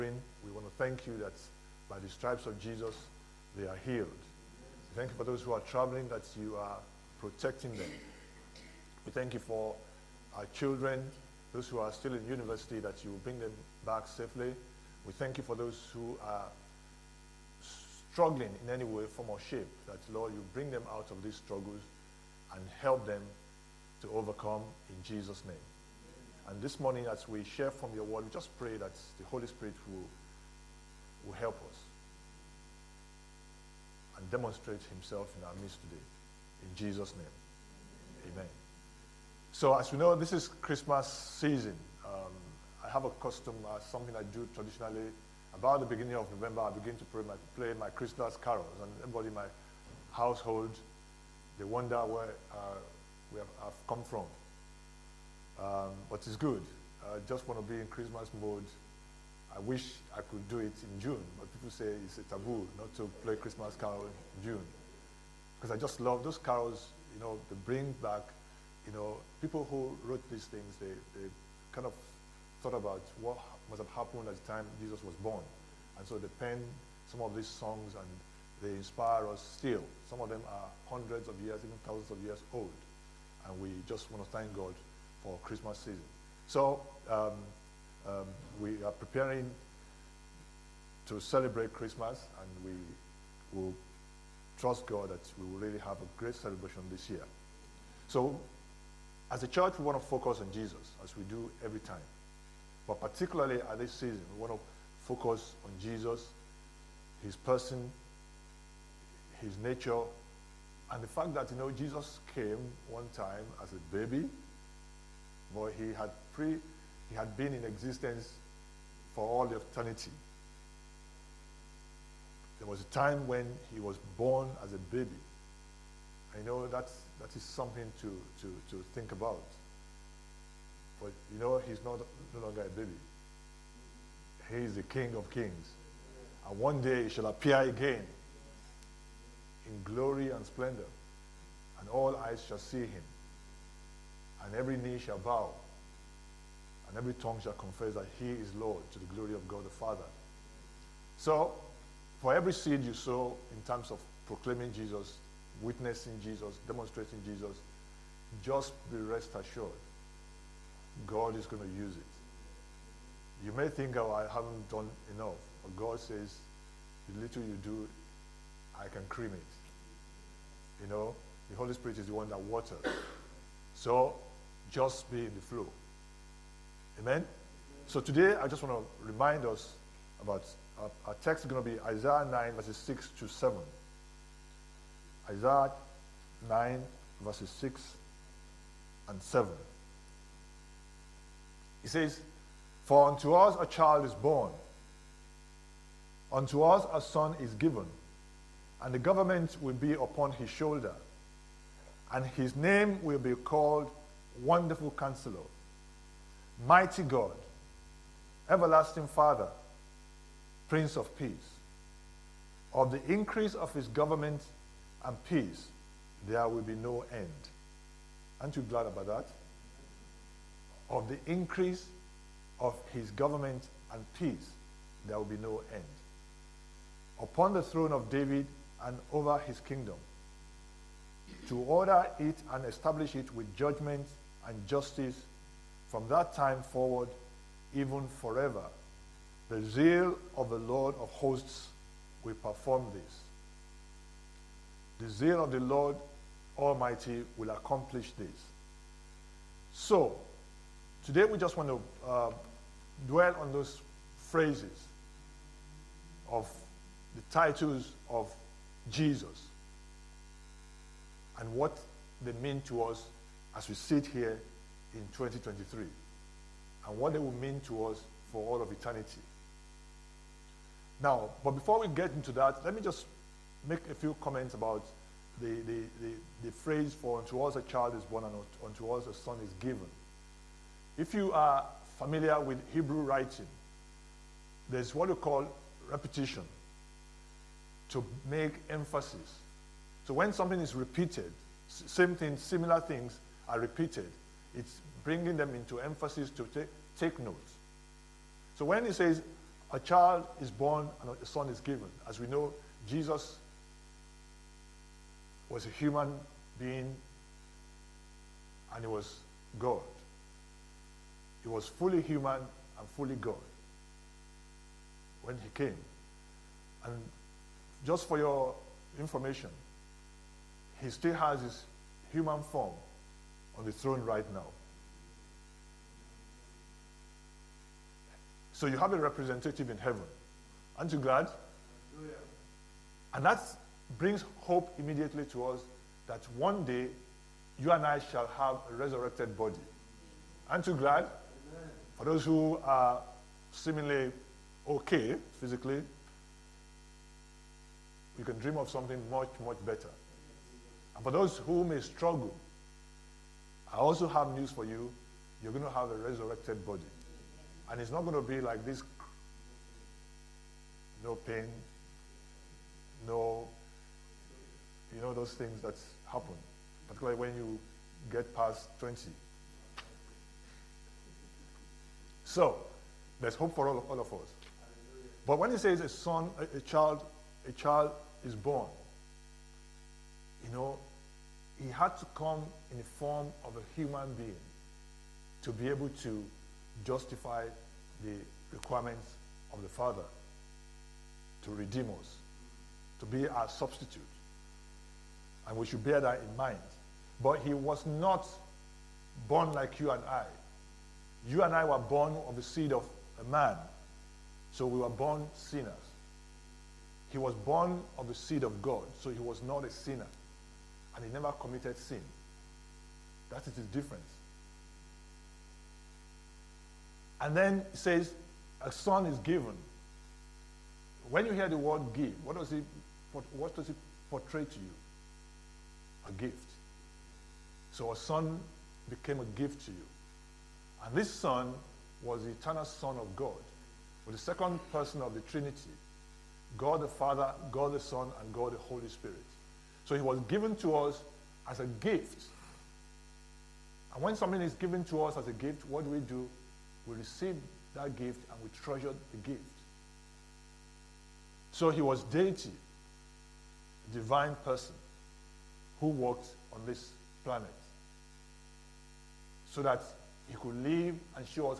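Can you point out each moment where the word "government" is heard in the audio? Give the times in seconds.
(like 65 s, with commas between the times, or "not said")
198 s, 213 s, 223 s.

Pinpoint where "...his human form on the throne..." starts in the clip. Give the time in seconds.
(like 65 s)
321 s.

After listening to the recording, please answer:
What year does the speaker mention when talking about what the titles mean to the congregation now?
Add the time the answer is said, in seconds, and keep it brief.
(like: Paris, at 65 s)
2023, at 265 s.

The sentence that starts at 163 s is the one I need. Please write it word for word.
You may think, oh, I haven't done enough.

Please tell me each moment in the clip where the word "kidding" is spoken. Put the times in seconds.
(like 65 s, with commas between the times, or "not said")
not said.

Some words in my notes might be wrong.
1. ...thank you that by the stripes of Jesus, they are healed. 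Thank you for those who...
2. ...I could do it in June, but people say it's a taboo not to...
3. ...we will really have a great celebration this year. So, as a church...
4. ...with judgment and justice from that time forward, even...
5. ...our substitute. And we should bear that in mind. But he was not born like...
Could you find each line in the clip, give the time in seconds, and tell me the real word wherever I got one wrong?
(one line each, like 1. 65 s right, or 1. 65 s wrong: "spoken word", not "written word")
1. 0 s right
2. 60 s right
3. 95 s right
4. 233 s right
5. 393 s right.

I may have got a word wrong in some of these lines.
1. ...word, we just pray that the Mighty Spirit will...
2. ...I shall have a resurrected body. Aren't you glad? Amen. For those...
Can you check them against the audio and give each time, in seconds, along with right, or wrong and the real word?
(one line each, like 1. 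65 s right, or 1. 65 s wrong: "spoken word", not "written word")
1. 28 s wrong: "Holy", not "Mighty"
2. 337 s right.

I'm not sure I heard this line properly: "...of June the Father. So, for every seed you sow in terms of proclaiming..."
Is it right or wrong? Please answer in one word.
wrong.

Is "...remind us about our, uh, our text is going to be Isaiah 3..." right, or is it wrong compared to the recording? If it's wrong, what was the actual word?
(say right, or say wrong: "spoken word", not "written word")
wrong: "9", not "3".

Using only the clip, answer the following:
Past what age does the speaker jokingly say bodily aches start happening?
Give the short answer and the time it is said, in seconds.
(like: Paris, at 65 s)
20, at 368 s.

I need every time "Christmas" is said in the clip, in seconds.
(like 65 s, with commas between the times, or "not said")
40 s, 47 s, 57 s, 63 s, 85 s, 91 s.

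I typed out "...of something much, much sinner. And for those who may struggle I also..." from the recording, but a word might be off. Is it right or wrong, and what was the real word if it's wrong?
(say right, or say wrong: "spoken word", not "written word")
wrong: "better", not "sinner".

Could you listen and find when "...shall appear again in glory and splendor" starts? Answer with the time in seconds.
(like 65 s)
137 s.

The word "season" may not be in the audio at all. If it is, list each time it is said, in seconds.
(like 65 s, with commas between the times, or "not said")
41 s, 85 s, 103 s.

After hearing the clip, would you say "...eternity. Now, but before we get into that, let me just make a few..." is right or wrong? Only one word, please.
right.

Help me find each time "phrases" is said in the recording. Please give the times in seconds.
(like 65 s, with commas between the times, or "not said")
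254 s, 276 s.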